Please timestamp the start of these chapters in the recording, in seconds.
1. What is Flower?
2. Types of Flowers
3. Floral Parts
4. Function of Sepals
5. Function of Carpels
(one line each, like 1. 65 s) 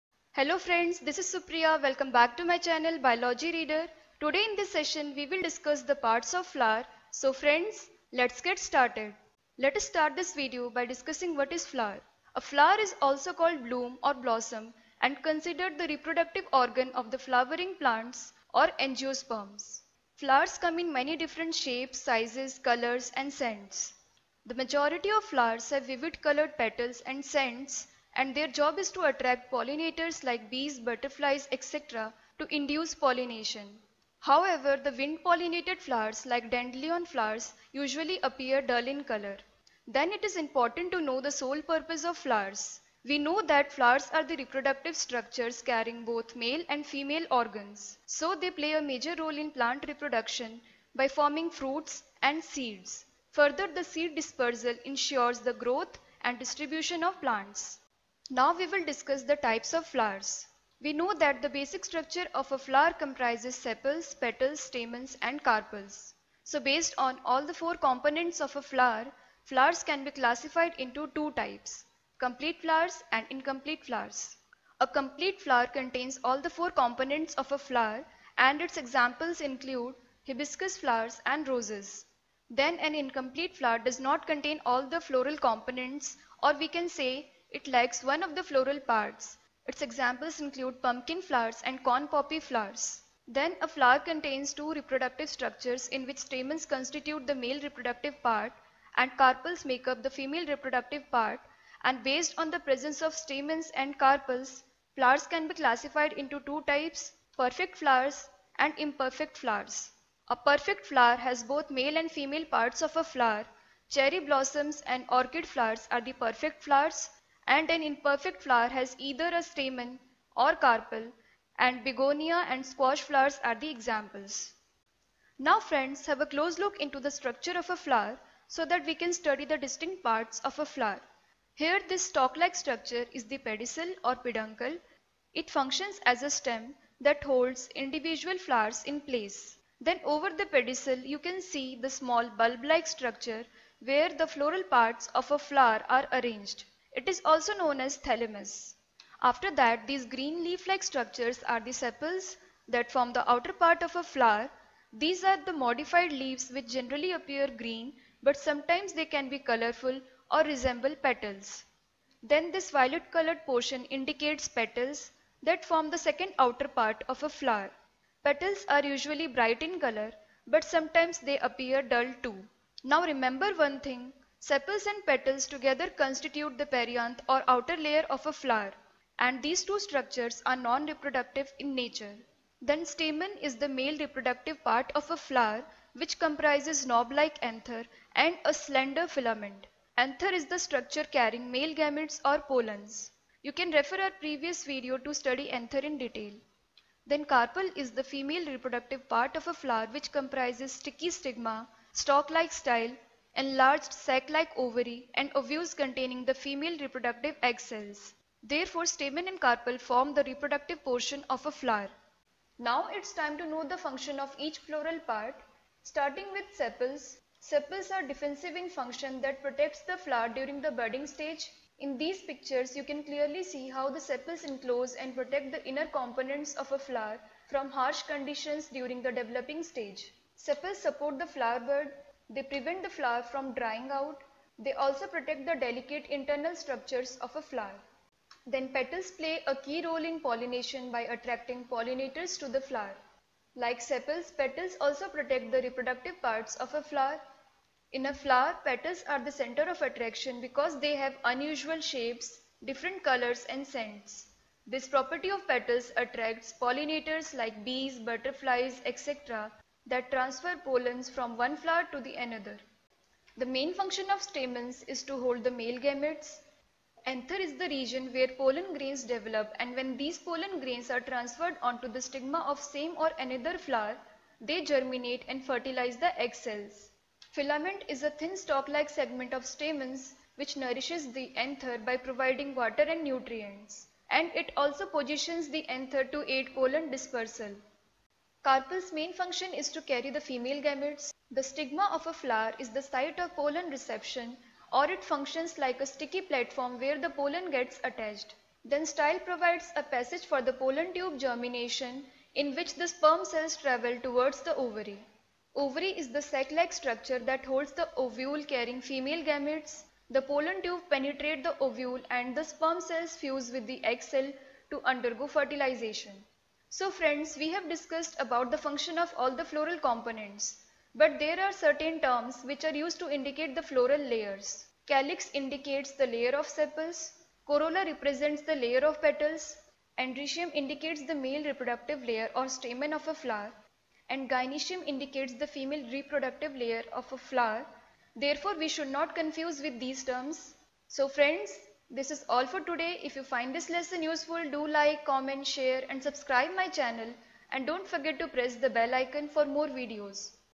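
1. 10 s
2. 58 s
3. 125 s
4. 213 s
5. 288 s.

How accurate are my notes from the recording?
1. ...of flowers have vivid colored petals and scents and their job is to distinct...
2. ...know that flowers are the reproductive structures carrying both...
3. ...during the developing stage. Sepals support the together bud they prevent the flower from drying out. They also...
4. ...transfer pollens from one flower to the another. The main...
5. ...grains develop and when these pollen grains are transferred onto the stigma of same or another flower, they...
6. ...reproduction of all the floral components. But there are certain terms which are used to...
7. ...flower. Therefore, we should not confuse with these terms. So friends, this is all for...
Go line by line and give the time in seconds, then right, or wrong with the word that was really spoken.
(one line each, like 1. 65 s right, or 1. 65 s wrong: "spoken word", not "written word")
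1. 25 s wrong: "attract", not "distinct"
2. 43 s right
3. 228 s wrong: "flower", not "together"
4. 260 s right
5. 268 s right
6. 318 s wrong: "function", not "reproduction"
7. 337 s right.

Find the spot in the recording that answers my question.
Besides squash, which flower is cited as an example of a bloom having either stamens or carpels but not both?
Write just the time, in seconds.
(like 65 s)
121 s.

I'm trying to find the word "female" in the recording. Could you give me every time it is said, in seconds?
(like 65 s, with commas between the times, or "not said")
46 s, 100 s, 112 s, 198 s, 206 s, 290 s, 308 s, 335 s.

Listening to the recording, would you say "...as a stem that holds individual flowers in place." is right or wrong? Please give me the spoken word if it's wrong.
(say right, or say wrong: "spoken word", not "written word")
right.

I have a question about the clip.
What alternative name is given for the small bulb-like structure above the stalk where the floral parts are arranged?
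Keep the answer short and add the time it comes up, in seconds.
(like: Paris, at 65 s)
thalamus, at 147 s.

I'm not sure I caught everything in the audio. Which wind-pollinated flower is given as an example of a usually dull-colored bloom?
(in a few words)
dandelion.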